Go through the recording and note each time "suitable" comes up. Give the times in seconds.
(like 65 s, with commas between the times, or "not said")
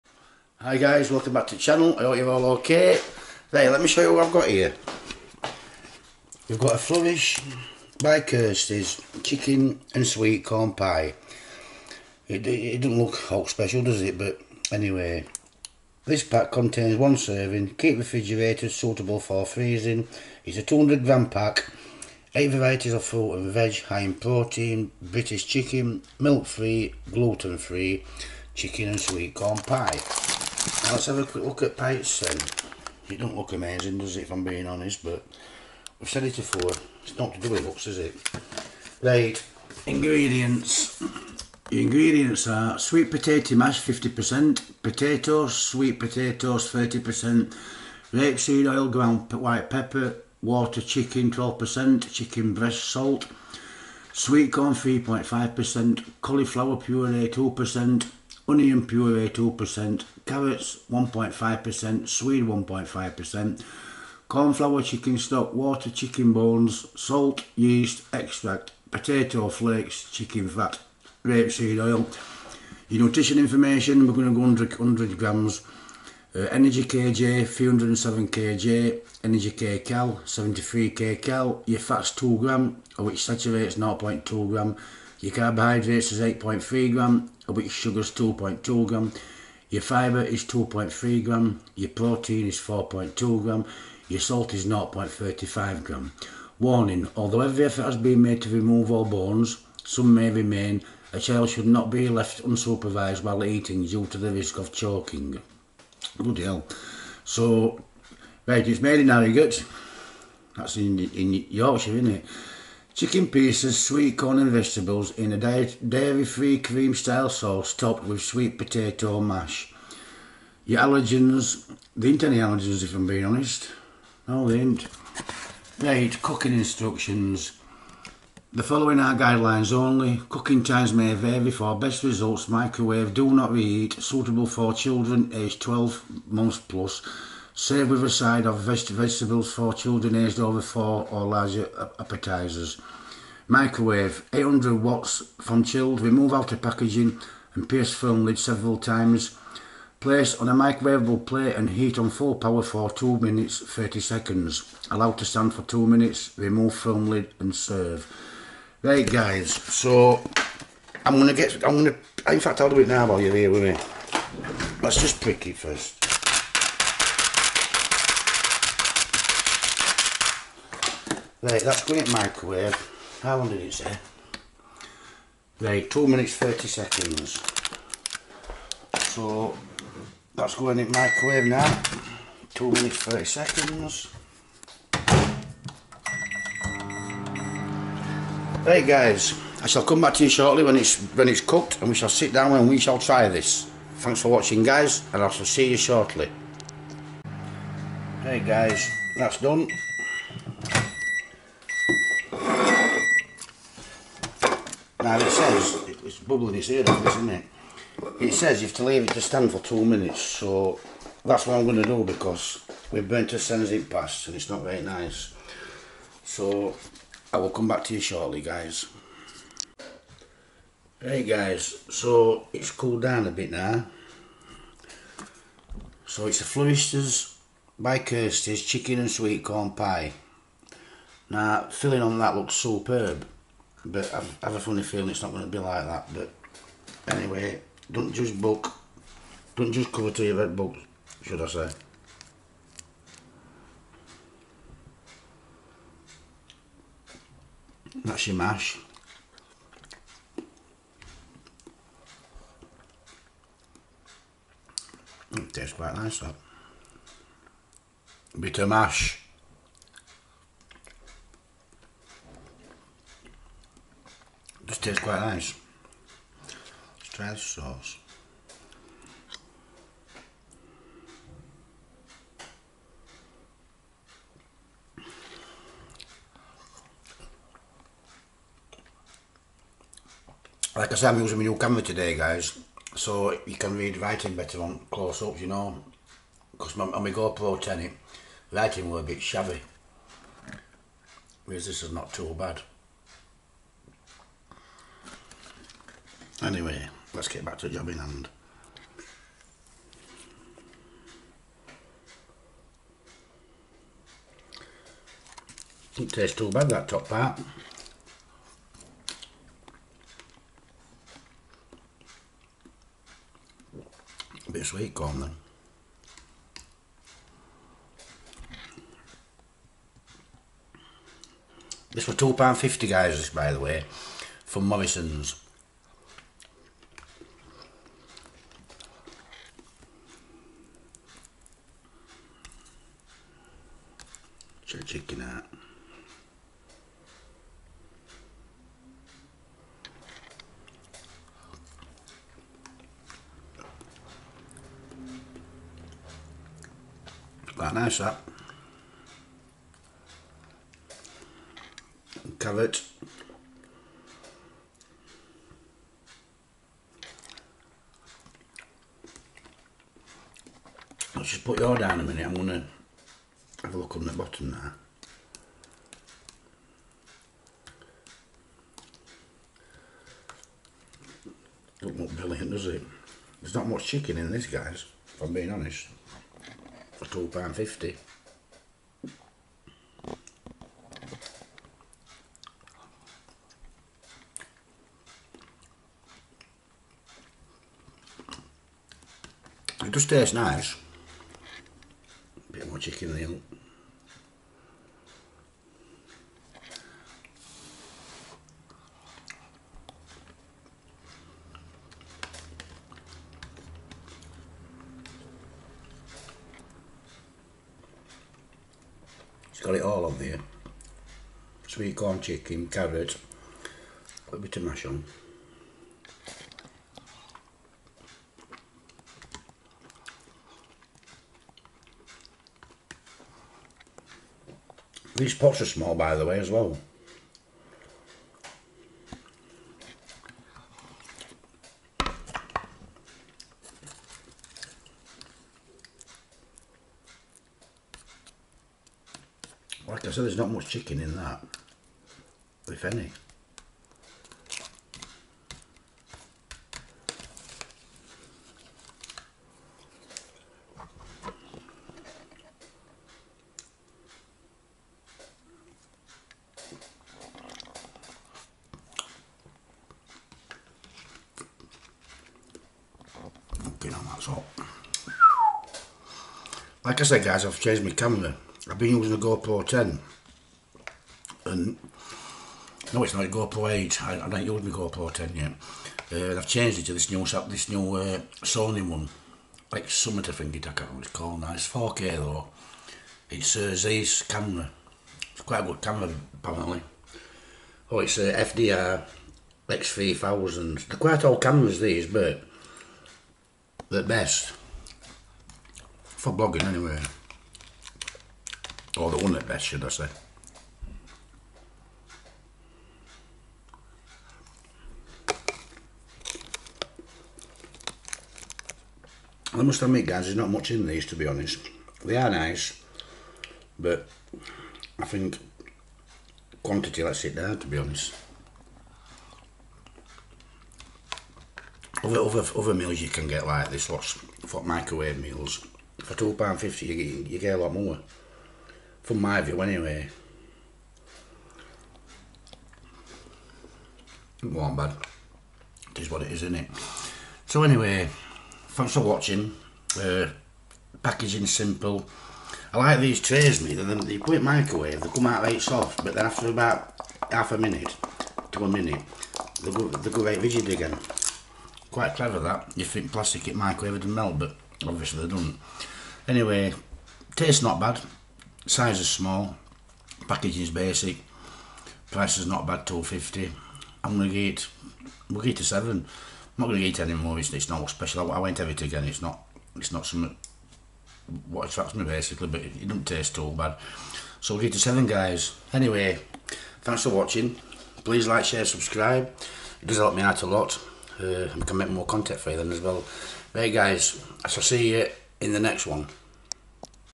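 18 s, 133 s.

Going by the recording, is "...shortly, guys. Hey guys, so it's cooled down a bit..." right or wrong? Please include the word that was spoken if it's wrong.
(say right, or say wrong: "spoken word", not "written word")
right.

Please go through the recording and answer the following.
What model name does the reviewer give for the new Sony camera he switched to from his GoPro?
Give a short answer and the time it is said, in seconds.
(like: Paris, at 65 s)
FDR X3000, at 488 s.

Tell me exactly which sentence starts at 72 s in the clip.
Your nutrition information, we're going to go 100, 100 grams.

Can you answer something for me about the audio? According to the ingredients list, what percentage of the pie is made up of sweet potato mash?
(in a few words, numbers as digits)
50%.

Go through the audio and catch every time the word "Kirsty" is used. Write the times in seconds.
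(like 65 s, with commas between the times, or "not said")
8 s, 227 s.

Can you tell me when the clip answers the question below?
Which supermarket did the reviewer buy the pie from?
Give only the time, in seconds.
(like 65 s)
324 s.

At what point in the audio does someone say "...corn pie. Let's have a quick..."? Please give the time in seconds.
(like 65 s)
29 s.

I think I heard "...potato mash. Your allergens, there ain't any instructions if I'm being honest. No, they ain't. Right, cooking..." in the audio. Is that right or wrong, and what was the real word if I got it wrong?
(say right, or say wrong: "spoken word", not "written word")
wrong: "allergens", not "instructions".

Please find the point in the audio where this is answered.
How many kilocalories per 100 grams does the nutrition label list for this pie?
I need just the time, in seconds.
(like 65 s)
80 s.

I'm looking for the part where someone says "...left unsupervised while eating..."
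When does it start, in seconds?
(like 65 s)
102 s.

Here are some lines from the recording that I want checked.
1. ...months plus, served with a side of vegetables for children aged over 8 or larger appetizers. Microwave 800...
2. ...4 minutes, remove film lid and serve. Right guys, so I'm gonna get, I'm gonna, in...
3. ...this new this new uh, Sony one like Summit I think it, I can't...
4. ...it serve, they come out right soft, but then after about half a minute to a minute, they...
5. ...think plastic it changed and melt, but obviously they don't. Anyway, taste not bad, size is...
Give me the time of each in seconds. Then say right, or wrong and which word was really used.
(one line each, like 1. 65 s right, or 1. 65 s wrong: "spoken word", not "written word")
1. 136 s wrong: "4", not "8"
2. 155 s wrong: "2", not "4"
3. 476 s right
4. 544 s wrong: "microwave", not "serve"
5. 552 s wrong: "microwaved", not "changed".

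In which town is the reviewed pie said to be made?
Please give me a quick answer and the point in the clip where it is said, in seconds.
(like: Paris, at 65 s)
Harrogate, at 109 s.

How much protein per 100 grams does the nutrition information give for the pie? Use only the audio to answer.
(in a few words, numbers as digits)
4.2 grams.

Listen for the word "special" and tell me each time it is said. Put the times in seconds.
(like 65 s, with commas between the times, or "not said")
13 s, 567 s.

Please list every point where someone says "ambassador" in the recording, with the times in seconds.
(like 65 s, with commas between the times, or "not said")
not said.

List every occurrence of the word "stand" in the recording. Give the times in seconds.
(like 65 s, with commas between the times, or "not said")
155 s, 209 s.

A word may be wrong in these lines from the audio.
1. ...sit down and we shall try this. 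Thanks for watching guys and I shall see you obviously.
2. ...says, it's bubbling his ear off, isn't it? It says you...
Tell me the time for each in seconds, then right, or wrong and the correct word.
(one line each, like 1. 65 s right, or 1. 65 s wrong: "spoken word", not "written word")
1. 192 s wrong: "shortly", not "obviously"
2. 205 s right.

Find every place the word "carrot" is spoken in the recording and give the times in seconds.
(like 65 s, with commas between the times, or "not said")
60 s, 352 s, 412 s.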